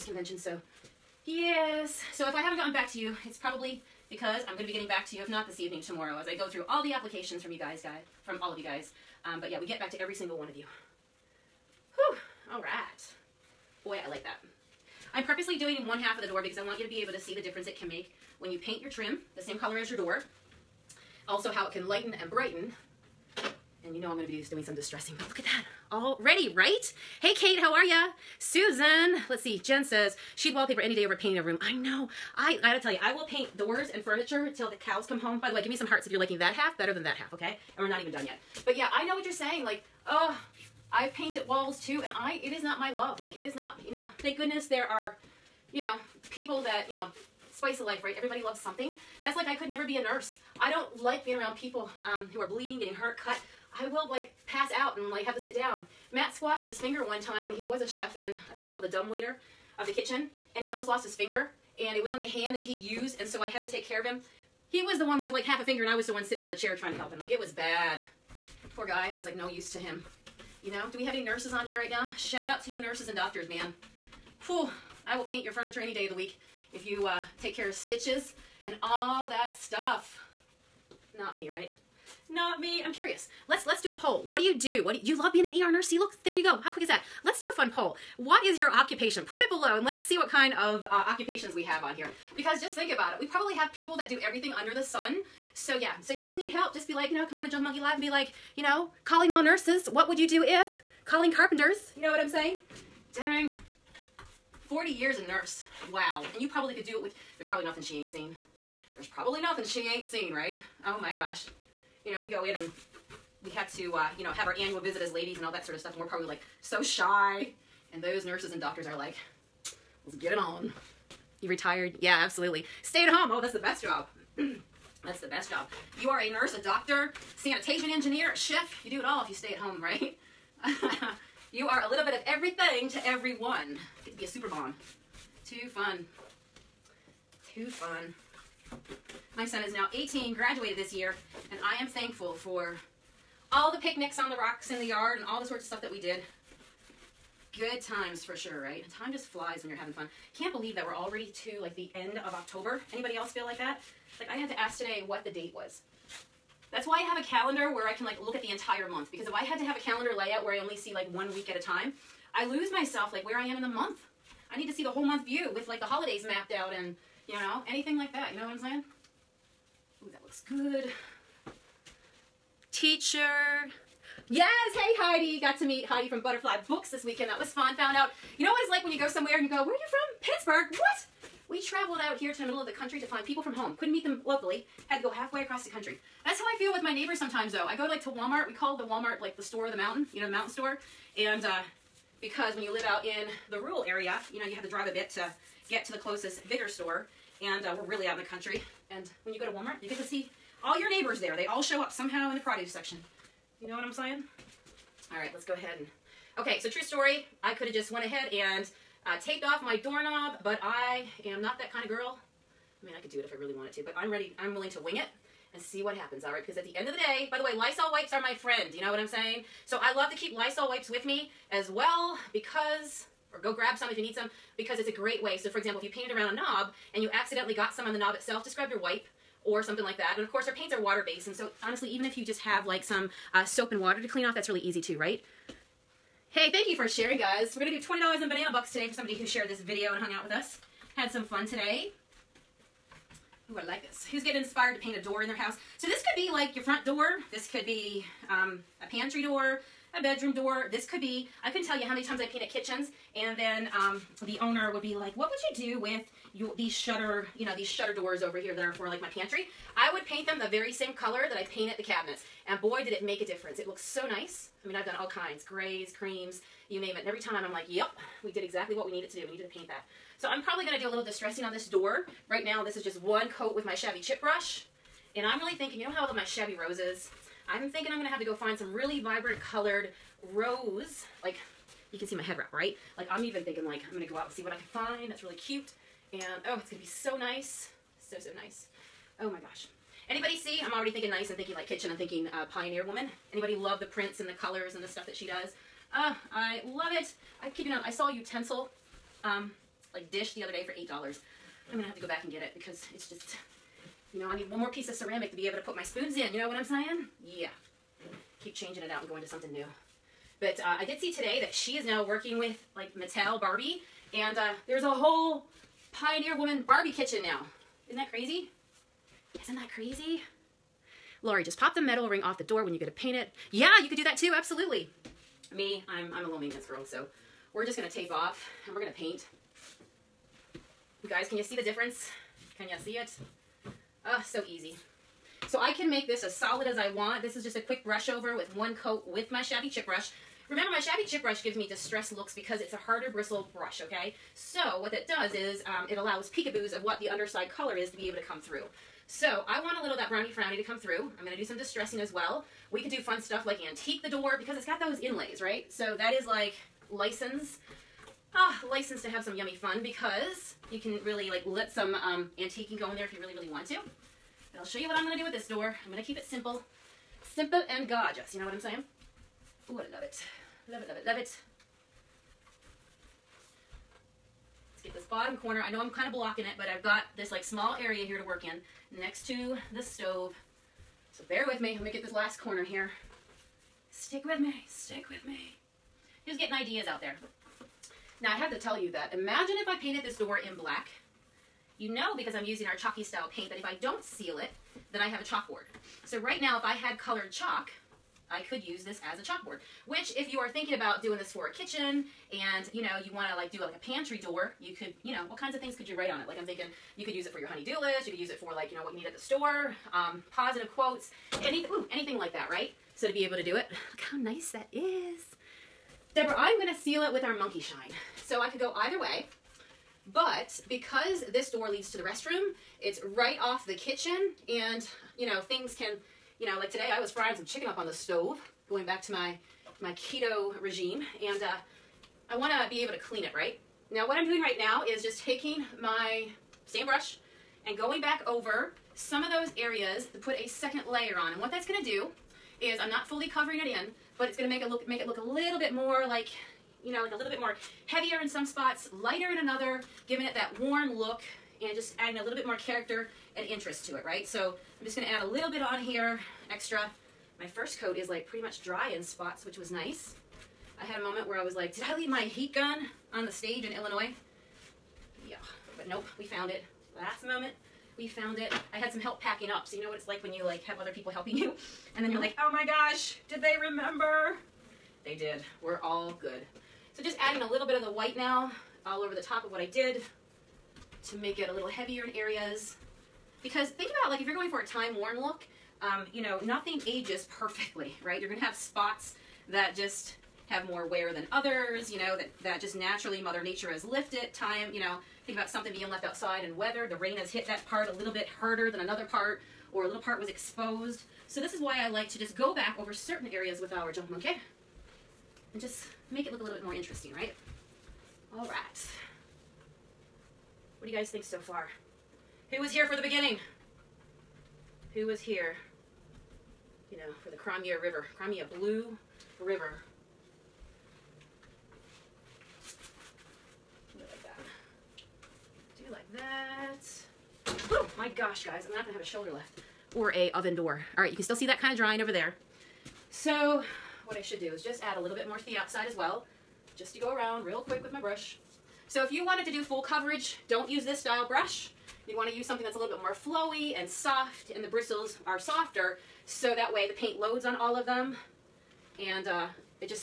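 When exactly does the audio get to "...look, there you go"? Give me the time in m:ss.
1:25.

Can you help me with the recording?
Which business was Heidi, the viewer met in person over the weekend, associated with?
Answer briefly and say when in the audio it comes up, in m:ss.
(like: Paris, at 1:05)
Butterfly Books, at 2:56.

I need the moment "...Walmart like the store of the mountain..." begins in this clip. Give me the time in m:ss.
3:08.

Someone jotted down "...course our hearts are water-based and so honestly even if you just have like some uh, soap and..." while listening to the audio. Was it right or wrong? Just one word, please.
wrong.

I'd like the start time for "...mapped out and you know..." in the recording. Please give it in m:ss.
2:46.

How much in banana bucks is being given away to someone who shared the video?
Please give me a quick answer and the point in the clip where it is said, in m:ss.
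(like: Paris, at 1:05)
$20, at 3:57.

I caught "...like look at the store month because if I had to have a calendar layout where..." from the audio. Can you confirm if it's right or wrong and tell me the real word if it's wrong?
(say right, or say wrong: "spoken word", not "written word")
wrong: "entire", not "store".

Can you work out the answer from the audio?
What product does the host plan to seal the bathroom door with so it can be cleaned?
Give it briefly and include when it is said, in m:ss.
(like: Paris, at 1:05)
Monkey Shine, at 6:57.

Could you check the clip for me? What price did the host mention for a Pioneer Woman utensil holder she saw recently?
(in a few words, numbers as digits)
$8.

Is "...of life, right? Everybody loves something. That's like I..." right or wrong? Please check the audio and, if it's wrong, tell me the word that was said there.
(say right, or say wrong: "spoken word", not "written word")
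right.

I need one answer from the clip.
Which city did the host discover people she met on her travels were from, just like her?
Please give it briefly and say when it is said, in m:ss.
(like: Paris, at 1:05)
Pittsburgh, at 3:00.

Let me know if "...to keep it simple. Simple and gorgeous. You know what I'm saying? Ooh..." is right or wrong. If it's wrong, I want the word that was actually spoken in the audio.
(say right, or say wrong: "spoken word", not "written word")
right.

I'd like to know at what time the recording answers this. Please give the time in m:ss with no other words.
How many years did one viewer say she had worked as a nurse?
1:44.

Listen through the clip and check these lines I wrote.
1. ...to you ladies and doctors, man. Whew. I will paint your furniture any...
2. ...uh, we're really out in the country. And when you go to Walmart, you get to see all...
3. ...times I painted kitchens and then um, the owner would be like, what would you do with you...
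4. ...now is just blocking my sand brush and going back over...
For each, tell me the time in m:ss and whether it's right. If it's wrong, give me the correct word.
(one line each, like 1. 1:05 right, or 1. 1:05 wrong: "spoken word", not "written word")
1. 1:12 wrong: "nurses", not "ladies"
2. 3:17 right
3. 4:12 right
4. 7:14 wrong: "taking", not "blocking".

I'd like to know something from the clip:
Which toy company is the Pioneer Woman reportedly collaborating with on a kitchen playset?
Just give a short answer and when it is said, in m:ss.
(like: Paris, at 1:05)
Mattel, at 5:12.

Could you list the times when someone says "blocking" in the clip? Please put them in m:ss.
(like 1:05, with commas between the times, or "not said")
6:16.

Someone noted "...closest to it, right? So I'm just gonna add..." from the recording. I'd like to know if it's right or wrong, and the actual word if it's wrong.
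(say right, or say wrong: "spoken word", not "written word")
wrong: "interest", not "closest".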